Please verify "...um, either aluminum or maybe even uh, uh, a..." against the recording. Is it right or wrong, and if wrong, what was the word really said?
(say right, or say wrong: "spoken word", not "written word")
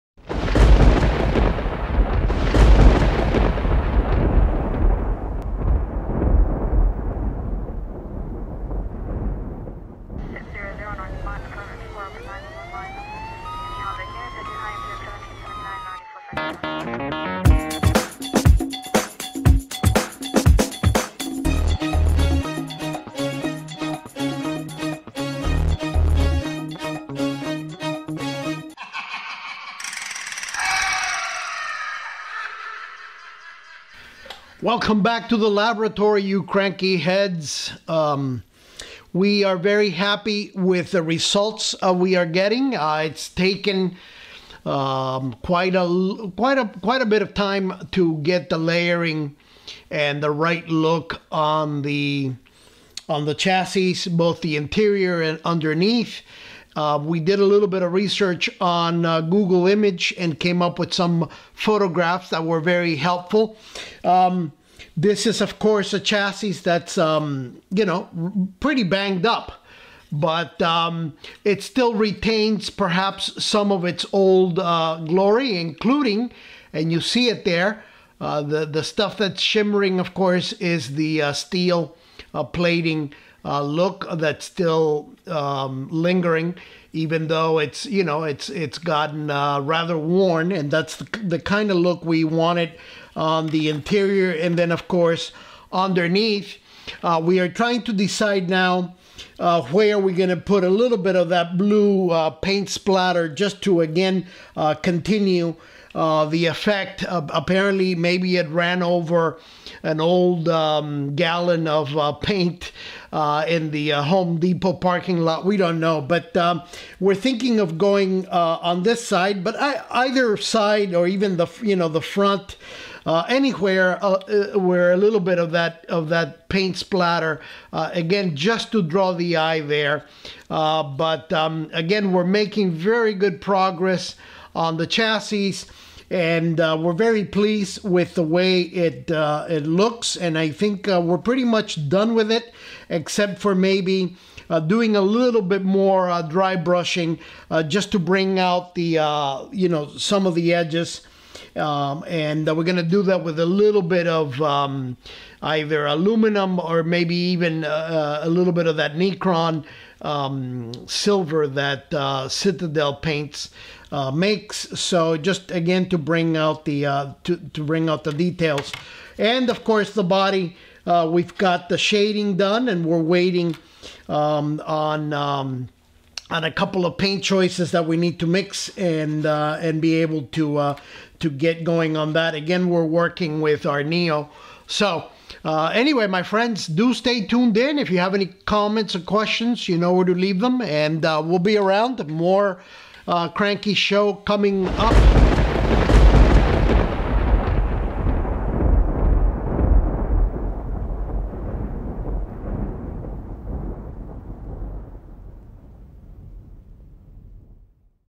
right.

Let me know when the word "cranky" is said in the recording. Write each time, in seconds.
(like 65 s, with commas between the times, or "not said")
36 s, 193 s.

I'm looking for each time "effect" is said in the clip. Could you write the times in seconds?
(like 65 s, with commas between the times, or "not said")
106 s.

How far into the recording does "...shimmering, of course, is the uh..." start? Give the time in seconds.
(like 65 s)
79 s.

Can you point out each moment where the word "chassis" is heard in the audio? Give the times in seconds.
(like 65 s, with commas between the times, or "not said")
53 s, 65 s, 134 s.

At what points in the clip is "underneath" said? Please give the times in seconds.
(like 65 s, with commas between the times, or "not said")
55 s, 95 s.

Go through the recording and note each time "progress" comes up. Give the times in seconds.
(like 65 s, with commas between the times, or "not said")
133 s.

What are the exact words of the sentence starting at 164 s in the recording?
So just again to bring out the uh, to to bring out the details, and of course the body.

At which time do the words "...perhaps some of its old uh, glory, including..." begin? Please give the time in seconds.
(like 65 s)
72 s.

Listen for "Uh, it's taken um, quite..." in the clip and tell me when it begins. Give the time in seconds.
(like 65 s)
42 s.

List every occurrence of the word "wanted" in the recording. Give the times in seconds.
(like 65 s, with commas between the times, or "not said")
92 s.